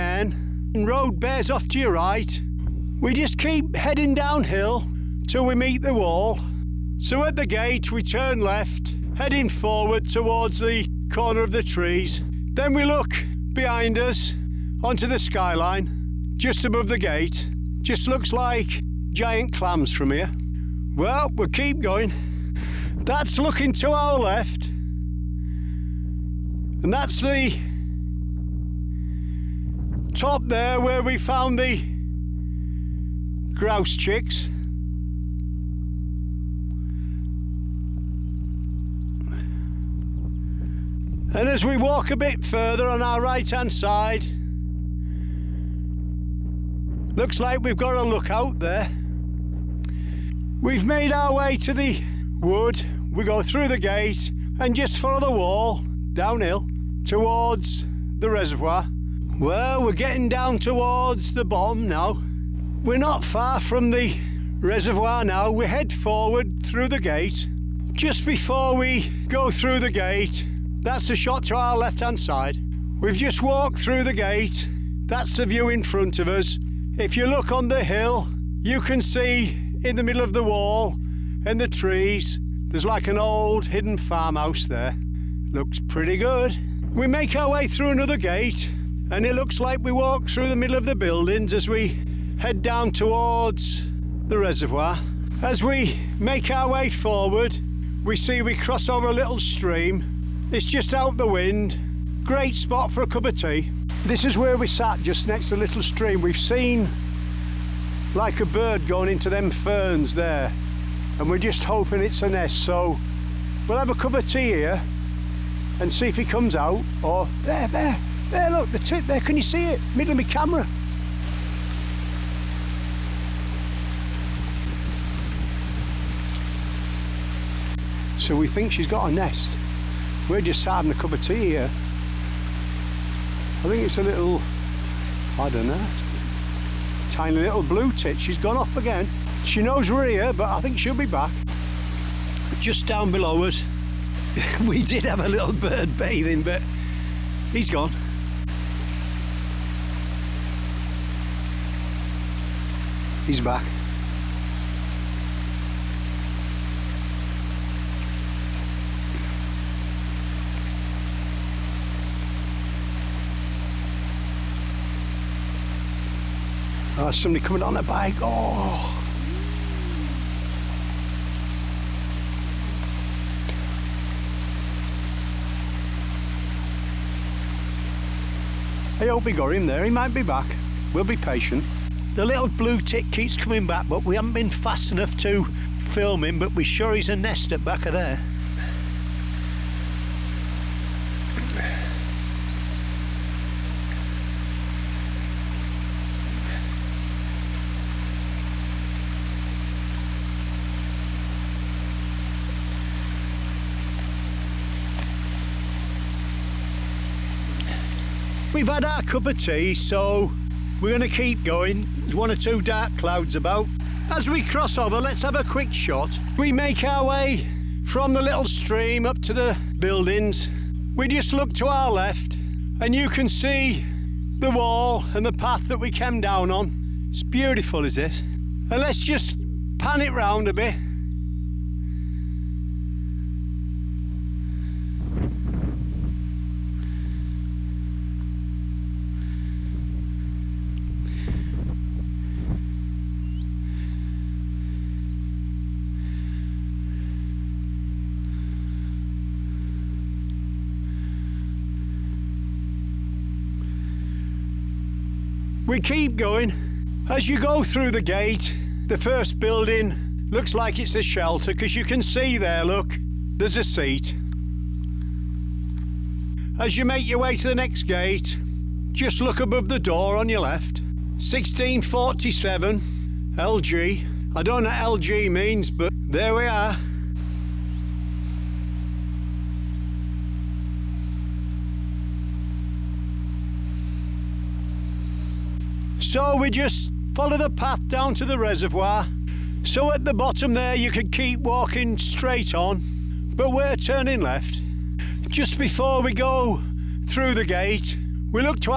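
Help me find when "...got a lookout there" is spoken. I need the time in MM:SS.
00:47.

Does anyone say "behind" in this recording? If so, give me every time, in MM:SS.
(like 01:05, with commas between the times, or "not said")
00:13.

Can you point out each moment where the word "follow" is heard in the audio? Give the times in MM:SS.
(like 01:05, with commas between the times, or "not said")
00:54, 04:47.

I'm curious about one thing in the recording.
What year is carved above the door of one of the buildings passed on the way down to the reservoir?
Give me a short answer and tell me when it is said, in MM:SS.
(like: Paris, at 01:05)
1647, at 04:31.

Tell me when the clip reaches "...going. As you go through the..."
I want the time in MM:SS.
04:16.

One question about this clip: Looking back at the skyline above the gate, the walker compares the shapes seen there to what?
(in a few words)
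Giant clams.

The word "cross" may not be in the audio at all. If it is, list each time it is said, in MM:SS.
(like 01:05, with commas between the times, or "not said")
01:38, 03:34.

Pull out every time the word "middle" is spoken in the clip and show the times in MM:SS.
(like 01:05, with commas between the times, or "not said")
01:20, 01:30, 01:59.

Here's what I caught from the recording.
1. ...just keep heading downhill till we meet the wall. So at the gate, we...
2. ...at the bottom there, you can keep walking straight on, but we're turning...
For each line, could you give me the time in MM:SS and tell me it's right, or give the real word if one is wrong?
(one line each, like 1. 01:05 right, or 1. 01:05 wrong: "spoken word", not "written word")
1. 00:03 right
2. 04:49 right.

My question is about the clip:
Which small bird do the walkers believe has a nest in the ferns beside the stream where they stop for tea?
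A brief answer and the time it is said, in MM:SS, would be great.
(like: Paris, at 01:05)
Blue tit, at 02:17.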